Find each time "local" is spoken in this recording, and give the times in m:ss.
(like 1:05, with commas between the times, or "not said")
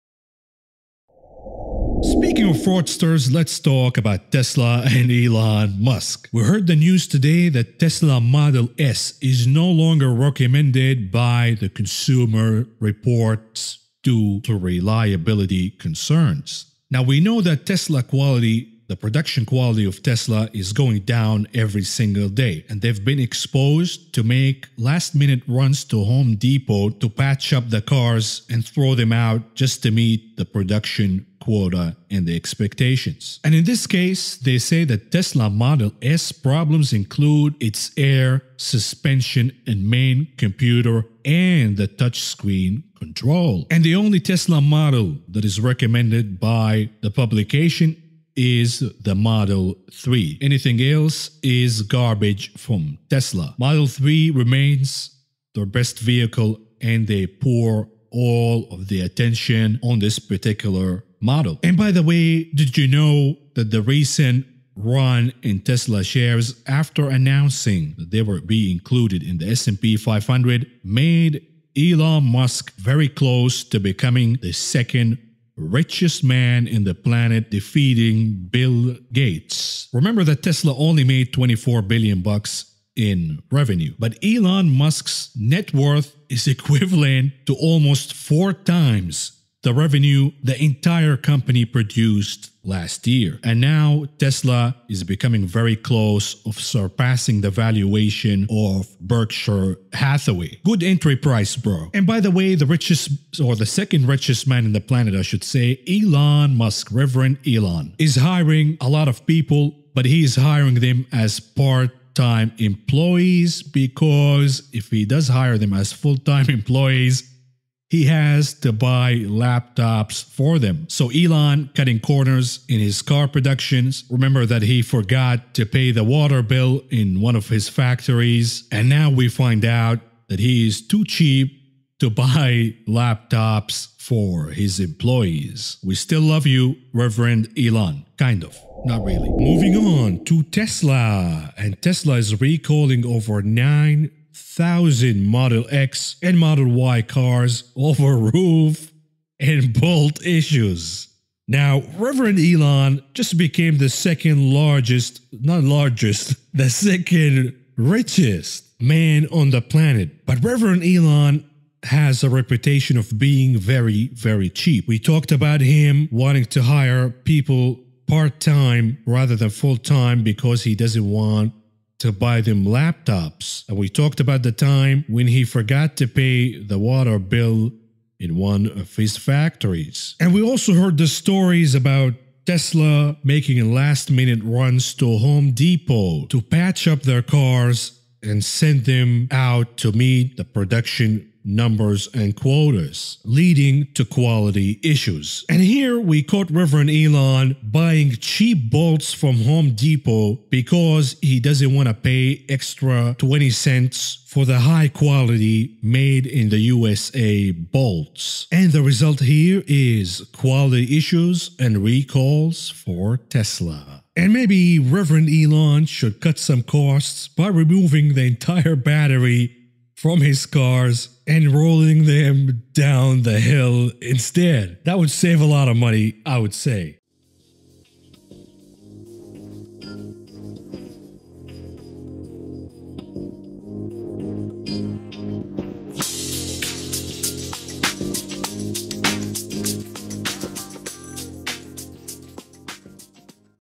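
not said.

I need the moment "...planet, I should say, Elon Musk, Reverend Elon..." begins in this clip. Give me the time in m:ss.
1:44.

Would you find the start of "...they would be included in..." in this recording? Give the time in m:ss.
1:08.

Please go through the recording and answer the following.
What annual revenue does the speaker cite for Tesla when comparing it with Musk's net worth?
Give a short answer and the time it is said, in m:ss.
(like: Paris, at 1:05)
24 billion, at 1:21.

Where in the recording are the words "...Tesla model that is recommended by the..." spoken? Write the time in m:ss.
0:44.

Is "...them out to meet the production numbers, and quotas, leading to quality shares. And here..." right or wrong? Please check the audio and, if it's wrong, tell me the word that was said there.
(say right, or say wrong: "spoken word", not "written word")
wrong: "issues", not "shares".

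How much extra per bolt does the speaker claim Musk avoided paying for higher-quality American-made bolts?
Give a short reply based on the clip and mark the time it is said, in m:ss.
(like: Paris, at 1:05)
20 cents, at 3:23.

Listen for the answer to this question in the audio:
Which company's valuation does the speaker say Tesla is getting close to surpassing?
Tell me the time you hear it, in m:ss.
1:38.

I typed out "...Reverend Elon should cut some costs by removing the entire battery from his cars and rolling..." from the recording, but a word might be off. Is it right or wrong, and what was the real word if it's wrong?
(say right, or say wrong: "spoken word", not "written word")
right.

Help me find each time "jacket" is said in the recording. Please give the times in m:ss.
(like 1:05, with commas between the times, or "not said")
not said.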